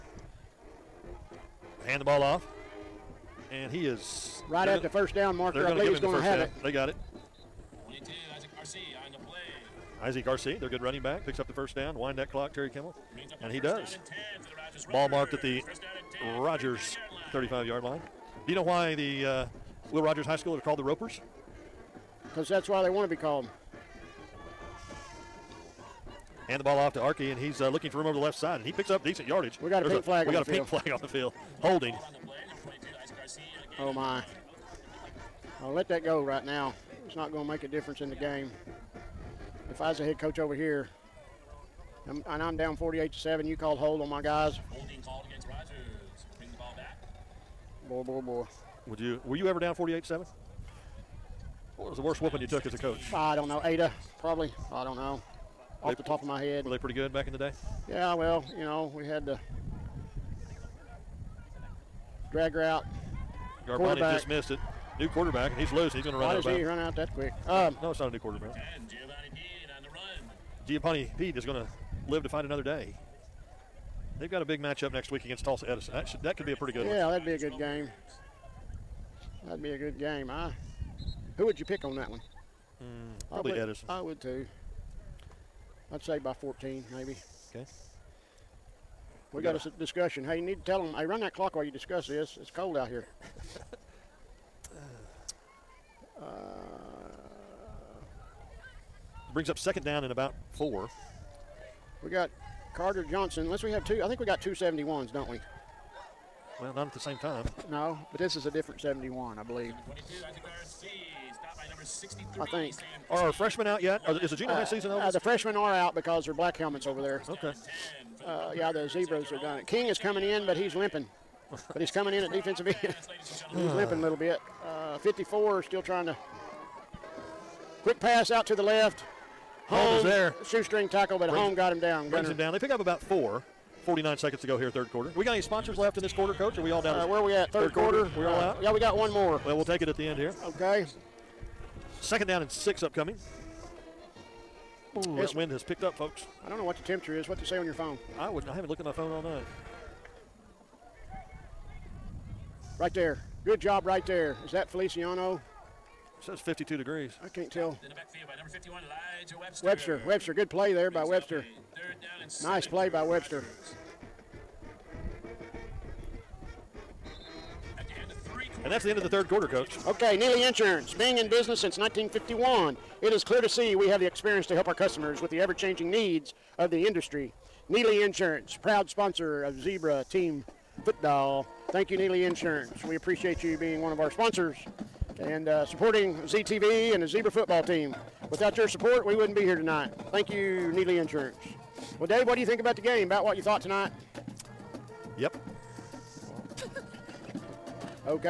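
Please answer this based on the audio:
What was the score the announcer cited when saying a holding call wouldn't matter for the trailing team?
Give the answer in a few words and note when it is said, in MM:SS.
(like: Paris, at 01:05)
48 to 7, at 00:42.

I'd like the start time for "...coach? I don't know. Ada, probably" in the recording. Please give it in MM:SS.
00:52.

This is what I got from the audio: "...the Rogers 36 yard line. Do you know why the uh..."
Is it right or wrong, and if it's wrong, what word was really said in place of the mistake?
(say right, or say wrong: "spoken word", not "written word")
wrong: "35", not "36".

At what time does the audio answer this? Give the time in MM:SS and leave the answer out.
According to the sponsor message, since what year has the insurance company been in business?
02:51.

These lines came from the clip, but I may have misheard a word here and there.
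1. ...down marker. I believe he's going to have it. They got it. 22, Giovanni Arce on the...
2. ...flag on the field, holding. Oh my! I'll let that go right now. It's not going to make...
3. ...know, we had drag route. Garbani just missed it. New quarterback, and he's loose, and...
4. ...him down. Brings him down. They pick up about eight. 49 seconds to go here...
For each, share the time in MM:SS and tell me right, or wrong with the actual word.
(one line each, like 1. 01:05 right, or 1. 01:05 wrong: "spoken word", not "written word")
1. 00:05 wrong: "Isaac", not "Giovanni"
2. 00:30 right
3. 00:58 right
4. 02:11 wrong: "four", not "eight".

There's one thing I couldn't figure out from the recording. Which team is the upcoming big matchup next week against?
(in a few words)
Tulsa Edison.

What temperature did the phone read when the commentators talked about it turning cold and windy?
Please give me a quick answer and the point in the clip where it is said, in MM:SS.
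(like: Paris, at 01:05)
52 degrees, at 02:36.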